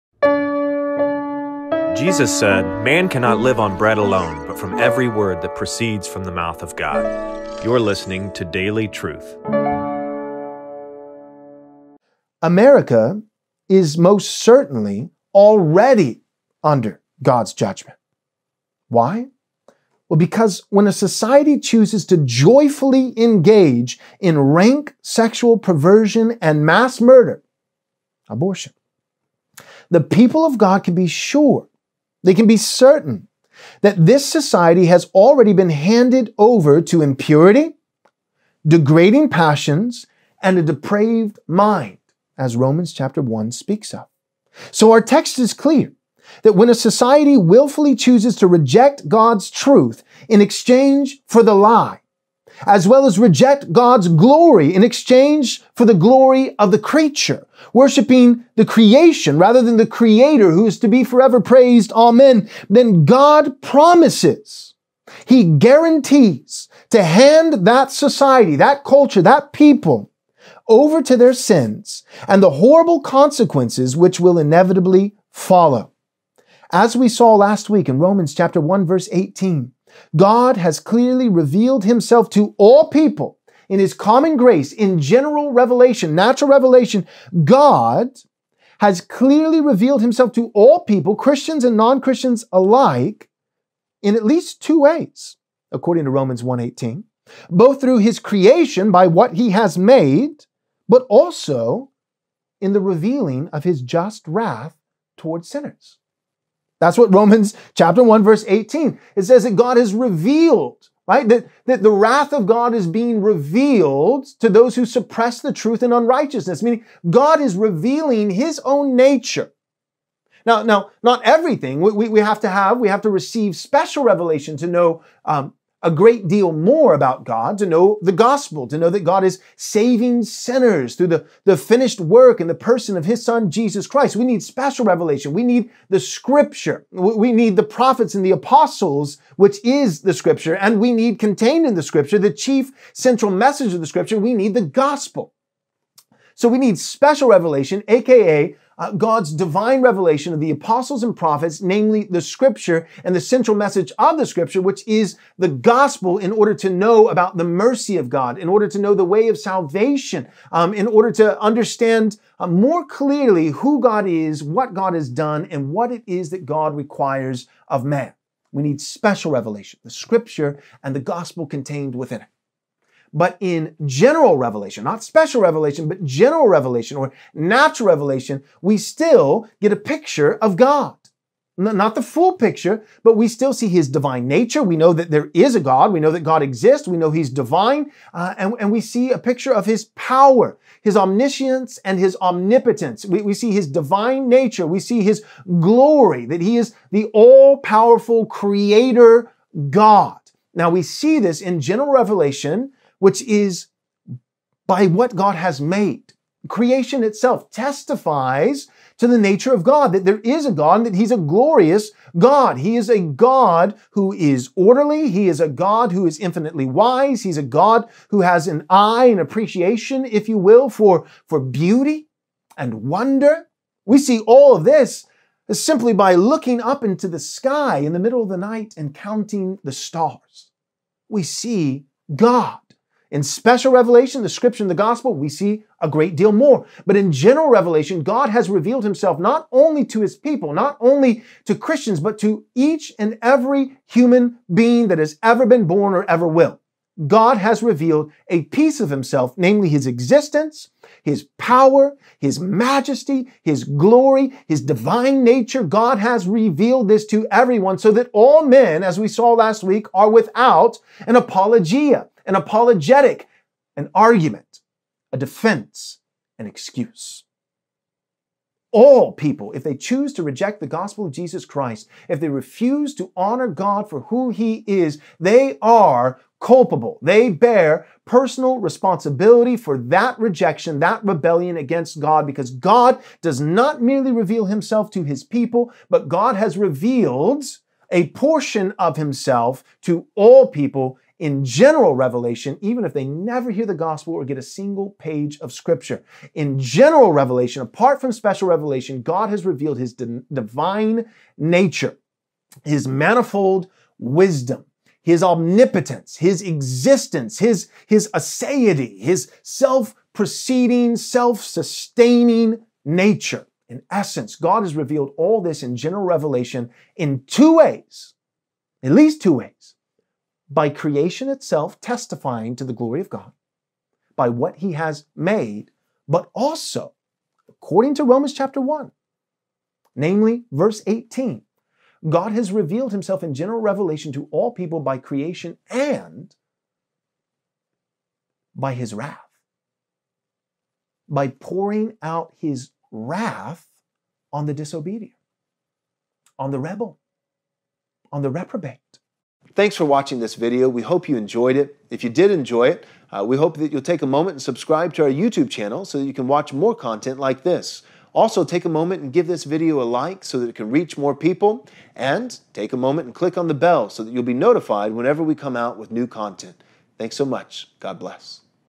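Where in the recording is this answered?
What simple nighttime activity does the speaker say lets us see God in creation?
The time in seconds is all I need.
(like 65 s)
228 s.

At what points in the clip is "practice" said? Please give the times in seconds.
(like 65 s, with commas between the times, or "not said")
not said.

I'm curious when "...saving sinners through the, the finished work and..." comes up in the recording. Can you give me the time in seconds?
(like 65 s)
129 s.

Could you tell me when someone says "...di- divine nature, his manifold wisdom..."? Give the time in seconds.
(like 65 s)
299 s.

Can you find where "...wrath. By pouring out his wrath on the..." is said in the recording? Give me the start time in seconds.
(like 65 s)
338 s.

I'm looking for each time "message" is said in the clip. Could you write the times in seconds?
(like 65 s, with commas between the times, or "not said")
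143 s, 153 s.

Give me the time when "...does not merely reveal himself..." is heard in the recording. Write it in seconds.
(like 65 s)
283 s.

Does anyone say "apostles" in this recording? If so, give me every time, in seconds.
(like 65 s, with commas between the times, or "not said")
138 s, 150 s.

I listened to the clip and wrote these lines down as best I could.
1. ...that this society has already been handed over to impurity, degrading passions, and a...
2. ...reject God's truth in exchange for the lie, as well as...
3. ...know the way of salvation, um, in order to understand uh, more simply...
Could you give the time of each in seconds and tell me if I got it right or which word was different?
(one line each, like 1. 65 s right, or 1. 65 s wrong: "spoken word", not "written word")
1. 33 s right
2. 48 s right
3. 158 s wrong: "clearly", not "simply".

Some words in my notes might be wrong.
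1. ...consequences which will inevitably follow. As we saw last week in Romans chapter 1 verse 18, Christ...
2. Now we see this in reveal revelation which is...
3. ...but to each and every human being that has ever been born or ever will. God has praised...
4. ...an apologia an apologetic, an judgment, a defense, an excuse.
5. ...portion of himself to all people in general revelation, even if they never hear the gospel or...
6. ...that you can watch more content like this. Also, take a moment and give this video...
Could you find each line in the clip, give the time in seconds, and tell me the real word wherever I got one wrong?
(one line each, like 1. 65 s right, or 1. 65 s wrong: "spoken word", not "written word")
1. 73 s wrong: "God", not "Christ"
2. 200 s wrong: "general", not "reveal"
3. 241 s wrong: "revealed", not "praised"
4. 261 s wrong: "argument", not "judgment"
5. 288 s right
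6. 355 s right.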